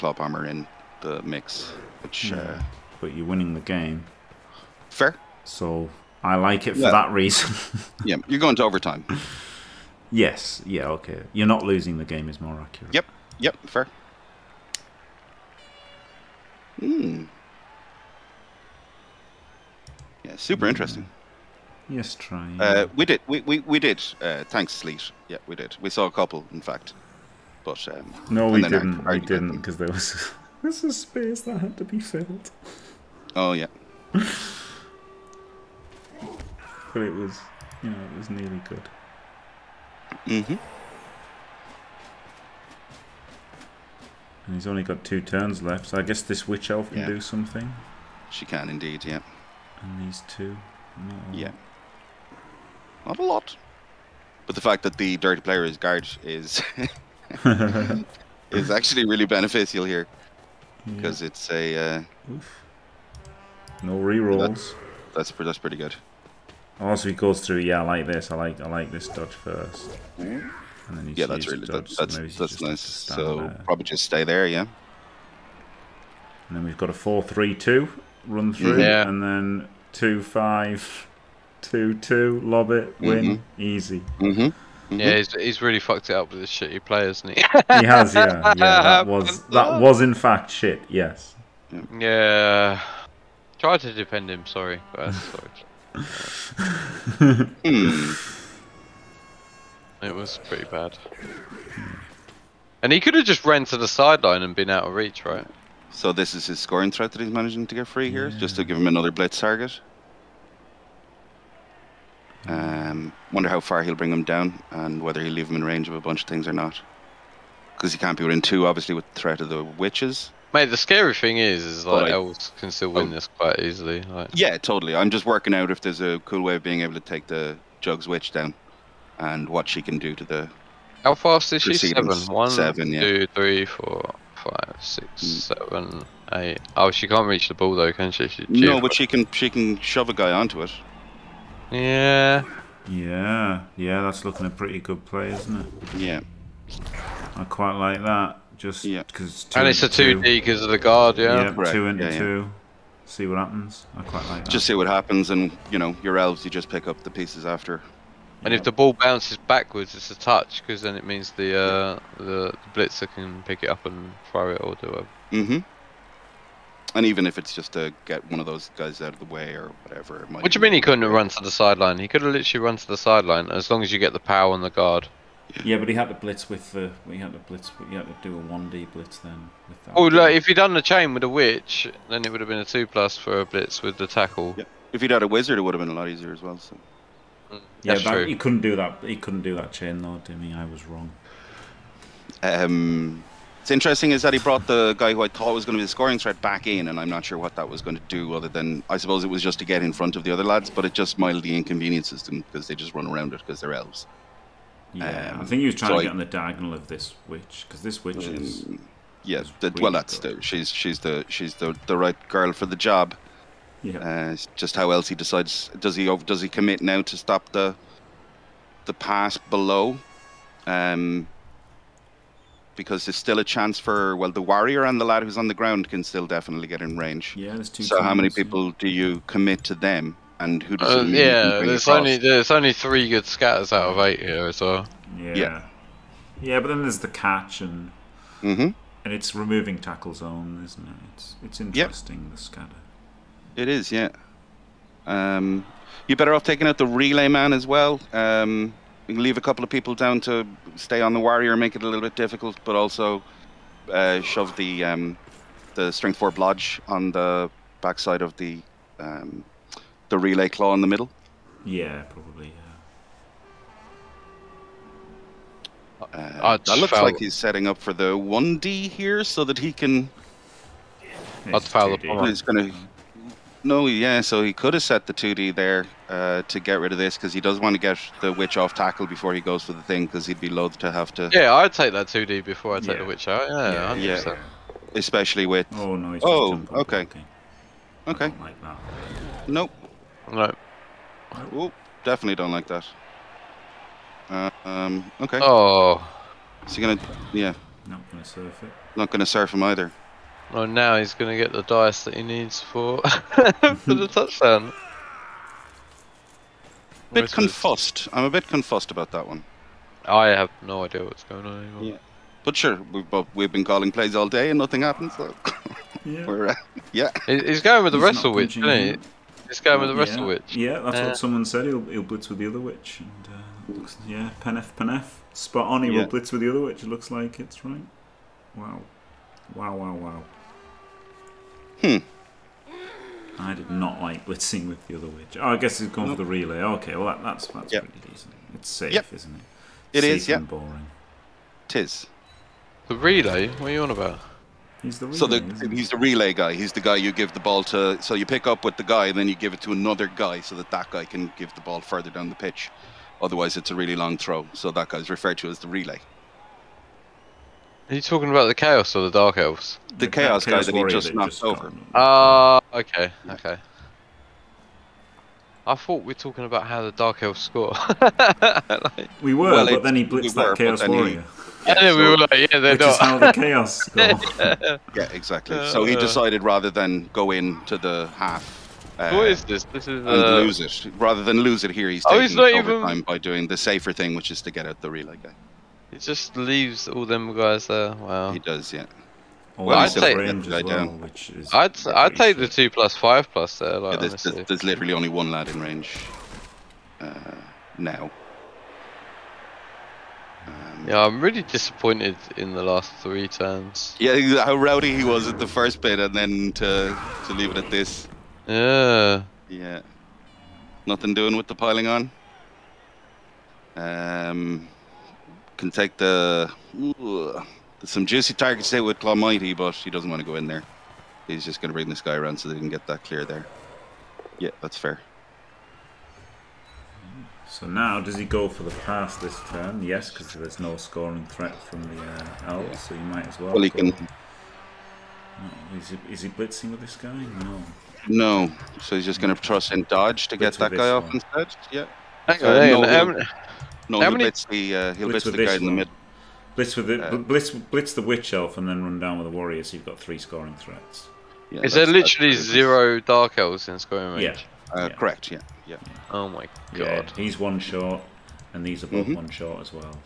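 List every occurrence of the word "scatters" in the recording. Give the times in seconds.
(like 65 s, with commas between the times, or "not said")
233 s, 242 s.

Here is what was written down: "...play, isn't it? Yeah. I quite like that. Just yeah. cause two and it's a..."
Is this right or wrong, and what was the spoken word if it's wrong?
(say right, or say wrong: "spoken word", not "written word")
right.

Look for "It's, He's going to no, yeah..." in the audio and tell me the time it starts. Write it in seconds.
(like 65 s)
271 s.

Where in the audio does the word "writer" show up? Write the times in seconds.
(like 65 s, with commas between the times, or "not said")
not said.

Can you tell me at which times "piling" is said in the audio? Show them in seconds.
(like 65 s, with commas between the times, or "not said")
411 s.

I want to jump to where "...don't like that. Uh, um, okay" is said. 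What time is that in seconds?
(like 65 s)
292 s.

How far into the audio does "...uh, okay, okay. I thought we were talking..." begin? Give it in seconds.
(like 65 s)
362 s.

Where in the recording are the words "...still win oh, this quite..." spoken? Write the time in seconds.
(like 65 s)
122 s.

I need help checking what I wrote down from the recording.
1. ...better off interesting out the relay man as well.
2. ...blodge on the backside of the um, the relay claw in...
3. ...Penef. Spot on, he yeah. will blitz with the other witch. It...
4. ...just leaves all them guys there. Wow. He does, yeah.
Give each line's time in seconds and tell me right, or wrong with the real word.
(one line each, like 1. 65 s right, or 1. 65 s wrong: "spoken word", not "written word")
1. 246 s wrong: "taking", not "interesting"
2. 256 s right
3. 324 s right
4. 385 s right.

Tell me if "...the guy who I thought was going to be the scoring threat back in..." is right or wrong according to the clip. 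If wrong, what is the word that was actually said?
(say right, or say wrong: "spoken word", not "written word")
right.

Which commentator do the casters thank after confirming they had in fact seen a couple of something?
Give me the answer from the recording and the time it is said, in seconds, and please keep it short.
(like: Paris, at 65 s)
Sleet, at 24 s.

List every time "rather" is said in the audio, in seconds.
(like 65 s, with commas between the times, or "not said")
376 s, 380 s.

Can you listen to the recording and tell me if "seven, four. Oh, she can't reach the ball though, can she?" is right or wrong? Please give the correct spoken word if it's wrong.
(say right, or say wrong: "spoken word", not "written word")
wrong: "eight", not "four".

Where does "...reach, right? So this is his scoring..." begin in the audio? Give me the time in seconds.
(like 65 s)
104 s.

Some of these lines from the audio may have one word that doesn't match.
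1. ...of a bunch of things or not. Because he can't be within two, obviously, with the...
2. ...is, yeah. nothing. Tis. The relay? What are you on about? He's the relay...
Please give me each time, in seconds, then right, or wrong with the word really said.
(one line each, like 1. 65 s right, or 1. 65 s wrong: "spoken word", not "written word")
1. 115 s right
2. 340 s wrong: "boring", not "nothing".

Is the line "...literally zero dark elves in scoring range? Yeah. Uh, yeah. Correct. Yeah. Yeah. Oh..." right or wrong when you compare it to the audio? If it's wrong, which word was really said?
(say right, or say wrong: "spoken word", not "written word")
right.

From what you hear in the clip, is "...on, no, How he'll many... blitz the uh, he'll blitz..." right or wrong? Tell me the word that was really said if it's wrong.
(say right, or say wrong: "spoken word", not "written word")
right.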